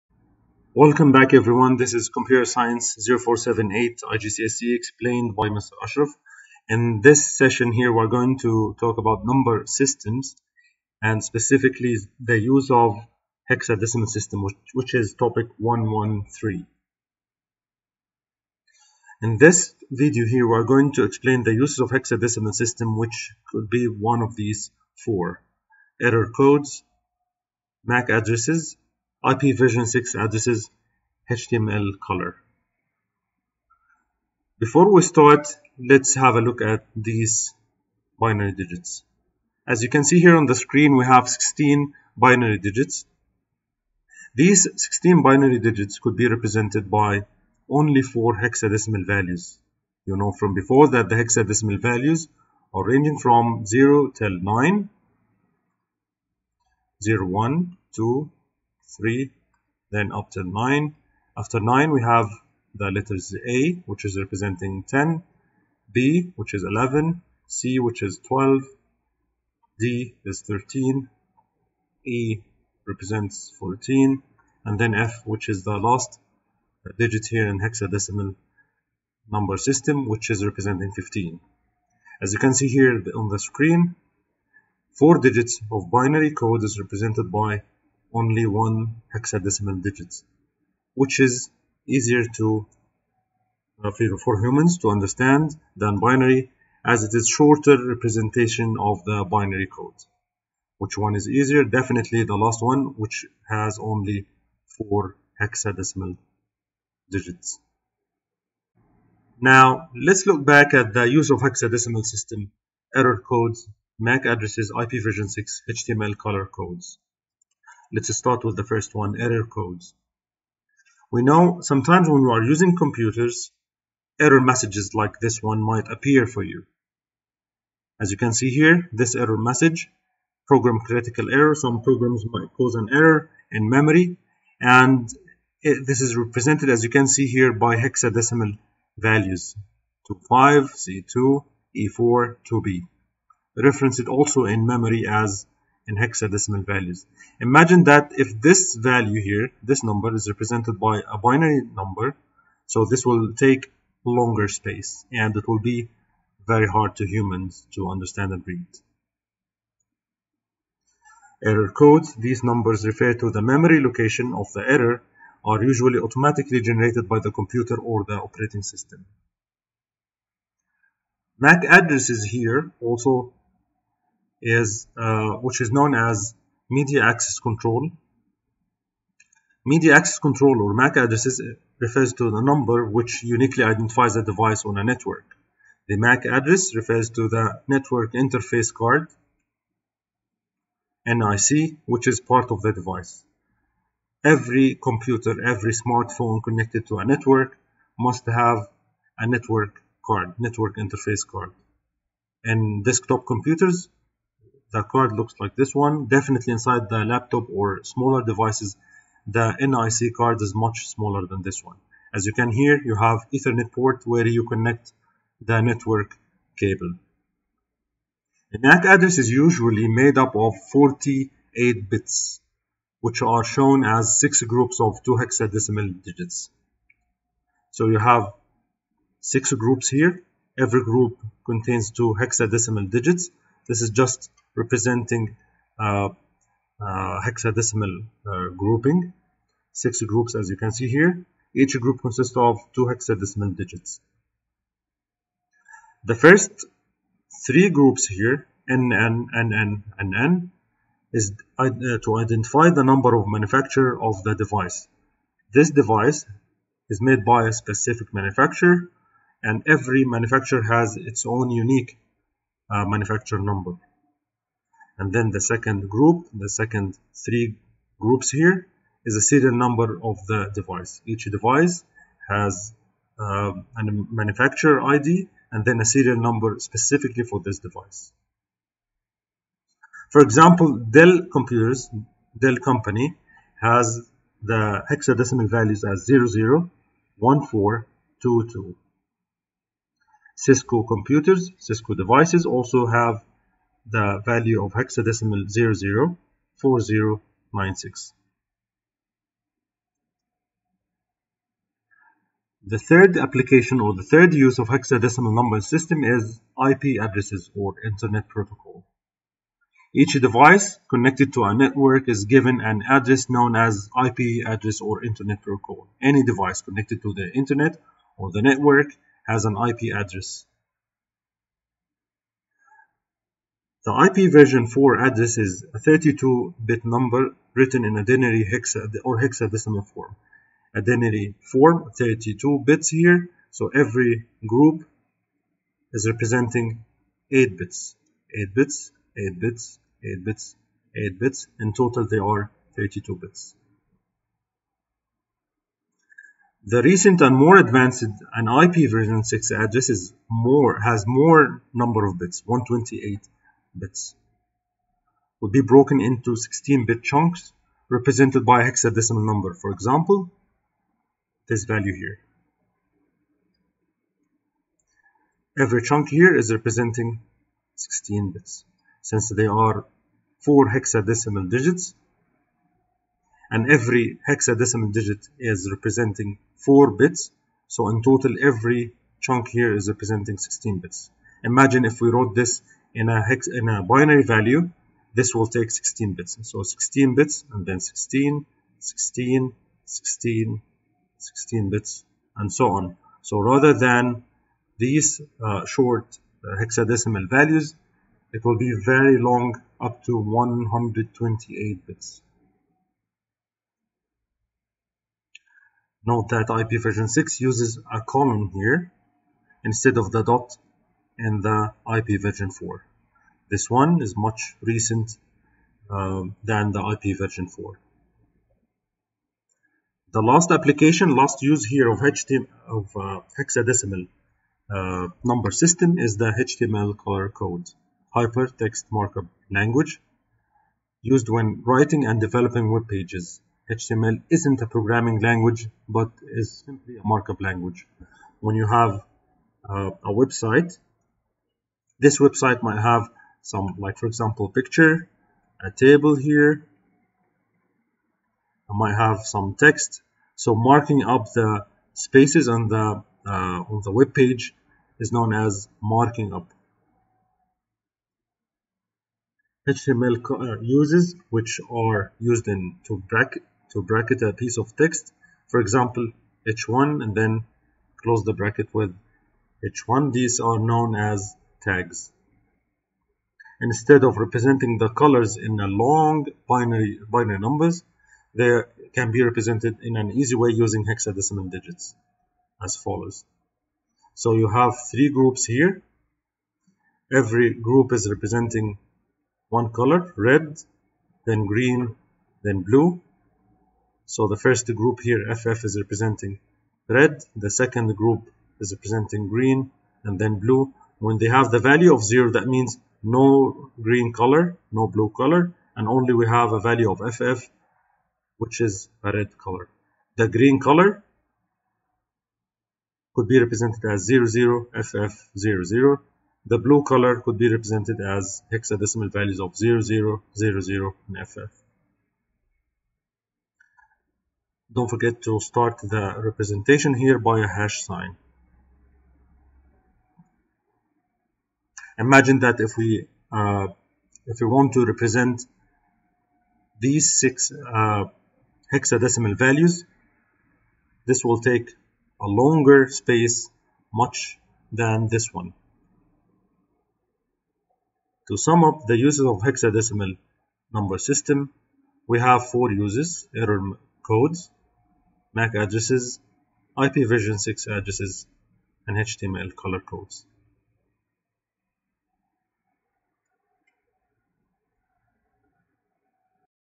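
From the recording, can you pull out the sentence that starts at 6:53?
This one is much recent um, than the IPv4.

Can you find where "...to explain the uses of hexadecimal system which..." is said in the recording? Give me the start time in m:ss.
0:20.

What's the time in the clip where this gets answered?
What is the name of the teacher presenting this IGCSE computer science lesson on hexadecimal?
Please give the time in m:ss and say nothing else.
0:05.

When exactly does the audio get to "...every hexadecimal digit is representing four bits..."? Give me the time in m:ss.
6:13.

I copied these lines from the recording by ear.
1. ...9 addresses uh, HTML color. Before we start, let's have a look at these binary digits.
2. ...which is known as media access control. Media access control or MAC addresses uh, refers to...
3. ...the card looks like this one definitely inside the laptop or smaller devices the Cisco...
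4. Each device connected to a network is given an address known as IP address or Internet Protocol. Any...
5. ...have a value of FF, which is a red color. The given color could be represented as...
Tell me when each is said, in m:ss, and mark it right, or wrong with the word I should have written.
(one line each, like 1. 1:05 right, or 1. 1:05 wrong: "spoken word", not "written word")
1. 0:29 wrong: "6", not "9"
2. 2:55 right
3. 3:24 wrong: "NIC", not "Cisco"
4. 5:09 right
5. 8:26 wrong: "green", not "given".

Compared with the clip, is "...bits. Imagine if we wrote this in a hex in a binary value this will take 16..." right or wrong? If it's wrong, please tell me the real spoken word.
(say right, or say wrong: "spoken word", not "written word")
right.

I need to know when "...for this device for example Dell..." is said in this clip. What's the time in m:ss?
4:37.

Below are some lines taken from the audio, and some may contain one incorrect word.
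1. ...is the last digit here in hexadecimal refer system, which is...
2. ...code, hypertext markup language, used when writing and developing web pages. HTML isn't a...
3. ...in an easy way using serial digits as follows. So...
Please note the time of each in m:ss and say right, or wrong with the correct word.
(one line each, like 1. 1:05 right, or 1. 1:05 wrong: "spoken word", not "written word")
1. 1:15 wrong: "number", not "refer"
2. 7:07 right
3. 7:59 wrong: "hexadecimal", not "serial".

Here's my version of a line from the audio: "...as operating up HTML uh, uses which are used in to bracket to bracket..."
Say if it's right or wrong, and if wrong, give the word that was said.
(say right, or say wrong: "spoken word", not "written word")
wrong: "marking", not "operating".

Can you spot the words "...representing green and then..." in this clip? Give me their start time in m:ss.
8:18.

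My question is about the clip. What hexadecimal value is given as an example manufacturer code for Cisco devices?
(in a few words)
004096.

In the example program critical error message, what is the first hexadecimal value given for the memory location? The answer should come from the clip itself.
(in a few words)
25.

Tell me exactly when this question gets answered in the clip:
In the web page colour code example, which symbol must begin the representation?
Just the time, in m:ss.
8:47.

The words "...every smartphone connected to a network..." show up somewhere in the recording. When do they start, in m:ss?
3:15.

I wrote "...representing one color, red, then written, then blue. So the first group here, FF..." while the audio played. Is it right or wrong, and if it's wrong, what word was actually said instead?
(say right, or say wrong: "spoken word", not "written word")
wrong: "green", not "written".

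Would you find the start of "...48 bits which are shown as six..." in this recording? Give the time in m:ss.
3:40.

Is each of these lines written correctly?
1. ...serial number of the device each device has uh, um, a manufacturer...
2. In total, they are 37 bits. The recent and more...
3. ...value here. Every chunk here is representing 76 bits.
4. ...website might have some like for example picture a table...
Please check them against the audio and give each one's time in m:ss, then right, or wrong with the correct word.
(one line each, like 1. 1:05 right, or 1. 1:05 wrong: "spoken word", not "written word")
1. 4:29 right
2. 5:41 wrong: "32", not "37"
3. 6:01 wrong: "16", not "76"
4. 7:22 right.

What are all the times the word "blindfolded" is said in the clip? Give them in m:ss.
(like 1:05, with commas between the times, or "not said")
not said.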